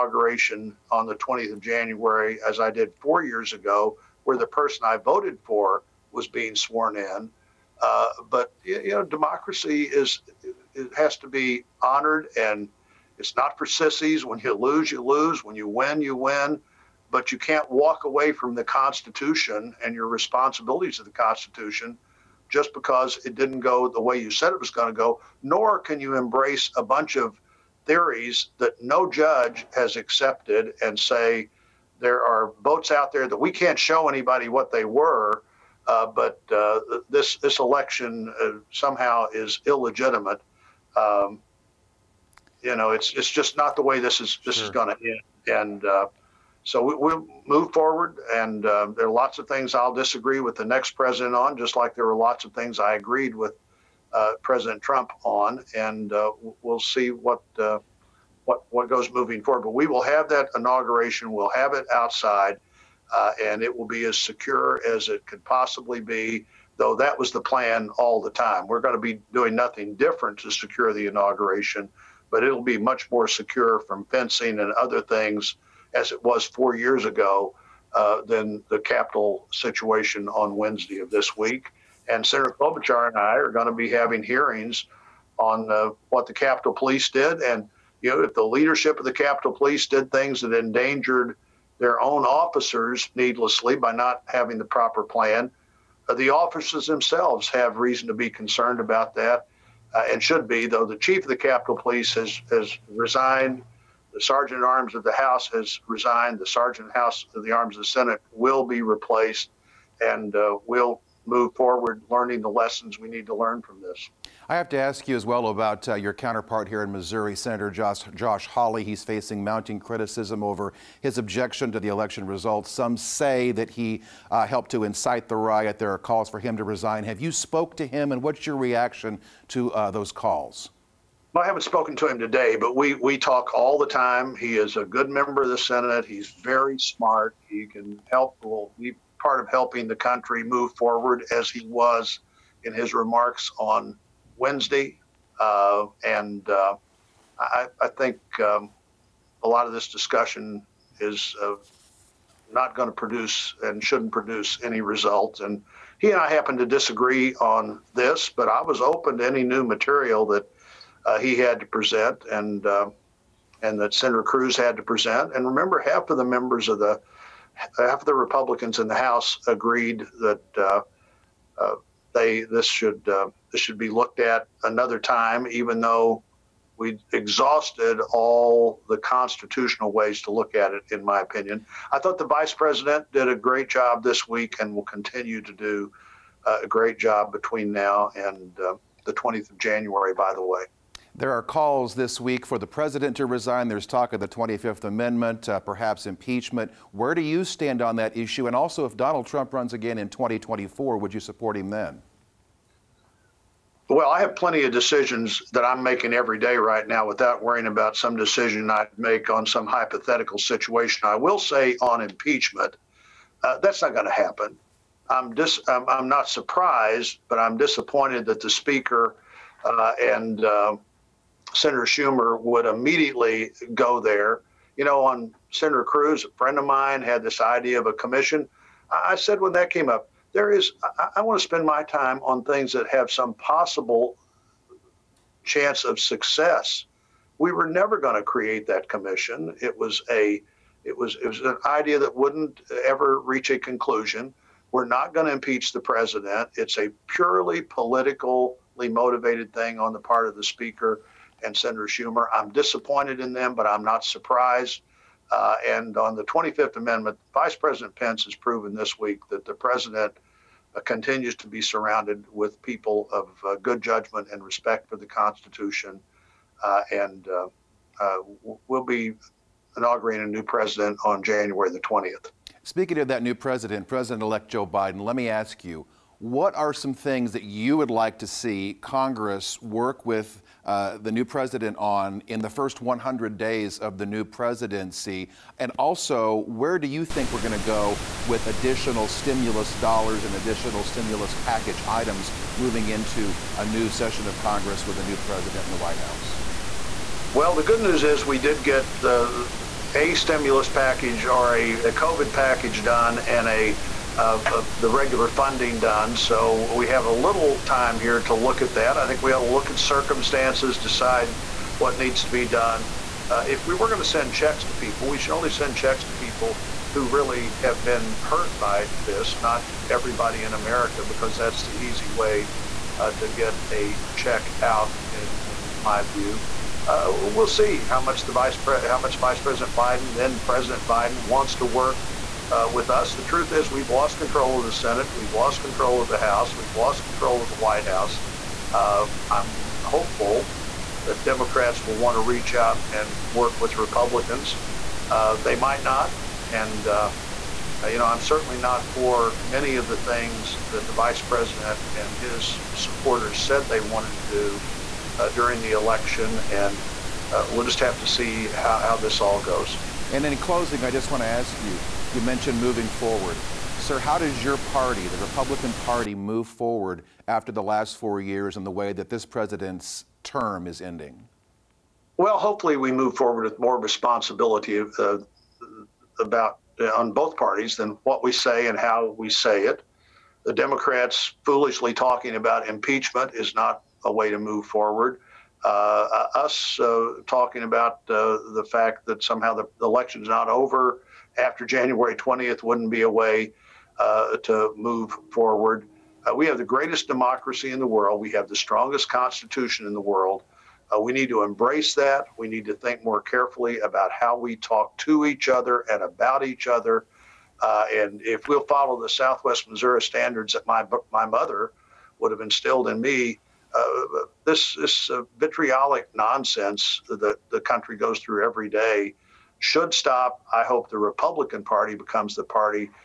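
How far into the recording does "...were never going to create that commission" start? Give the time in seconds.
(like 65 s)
237 s.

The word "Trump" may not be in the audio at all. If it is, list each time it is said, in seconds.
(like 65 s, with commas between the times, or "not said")
54 s, 199 s.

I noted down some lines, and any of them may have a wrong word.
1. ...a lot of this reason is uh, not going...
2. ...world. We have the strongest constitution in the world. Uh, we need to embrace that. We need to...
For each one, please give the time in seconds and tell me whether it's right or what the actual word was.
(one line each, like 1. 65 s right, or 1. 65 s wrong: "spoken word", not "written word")
1. 149 s wrong: "discussion", not "reason"
2. 397 s right.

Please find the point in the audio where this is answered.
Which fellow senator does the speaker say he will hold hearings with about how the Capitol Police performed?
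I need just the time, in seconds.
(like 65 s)
82 s.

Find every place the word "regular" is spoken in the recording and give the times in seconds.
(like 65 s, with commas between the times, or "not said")
304 s.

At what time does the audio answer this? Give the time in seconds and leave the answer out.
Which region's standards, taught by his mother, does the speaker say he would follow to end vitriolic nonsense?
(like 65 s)
409 s.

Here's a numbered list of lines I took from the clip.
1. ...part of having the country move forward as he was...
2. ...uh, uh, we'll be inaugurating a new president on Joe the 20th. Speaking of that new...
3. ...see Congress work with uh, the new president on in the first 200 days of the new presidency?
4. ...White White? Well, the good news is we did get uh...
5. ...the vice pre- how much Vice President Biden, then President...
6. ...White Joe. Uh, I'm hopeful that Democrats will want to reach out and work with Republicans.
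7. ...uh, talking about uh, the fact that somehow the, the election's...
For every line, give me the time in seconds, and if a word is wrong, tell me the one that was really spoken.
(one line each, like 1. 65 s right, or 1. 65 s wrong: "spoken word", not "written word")
1. 139 s wrong: "helping", not "having"
2. 267 s wrong: "January", not "Joe"
3. 278 s wrong: "100", not "200"
4. 295 s wrong: "House", not "White"
5. 328 s right
6. 337 s wrong: "House", not "Joe"
7. 386 s right.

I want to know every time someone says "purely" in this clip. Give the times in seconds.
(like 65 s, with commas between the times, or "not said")
247 s.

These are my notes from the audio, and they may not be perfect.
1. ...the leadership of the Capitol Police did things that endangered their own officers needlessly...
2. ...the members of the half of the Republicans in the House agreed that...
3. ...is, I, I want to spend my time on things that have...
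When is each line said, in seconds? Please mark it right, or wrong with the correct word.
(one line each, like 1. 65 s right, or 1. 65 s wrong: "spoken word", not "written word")
1. 88 s right
2. 166 s right
3. 230 s right.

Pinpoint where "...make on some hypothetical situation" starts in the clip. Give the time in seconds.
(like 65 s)
208 s.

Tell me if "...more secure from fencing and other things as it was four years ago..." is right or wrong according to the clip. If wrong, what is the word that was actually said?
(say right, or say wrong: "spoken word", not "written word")
right.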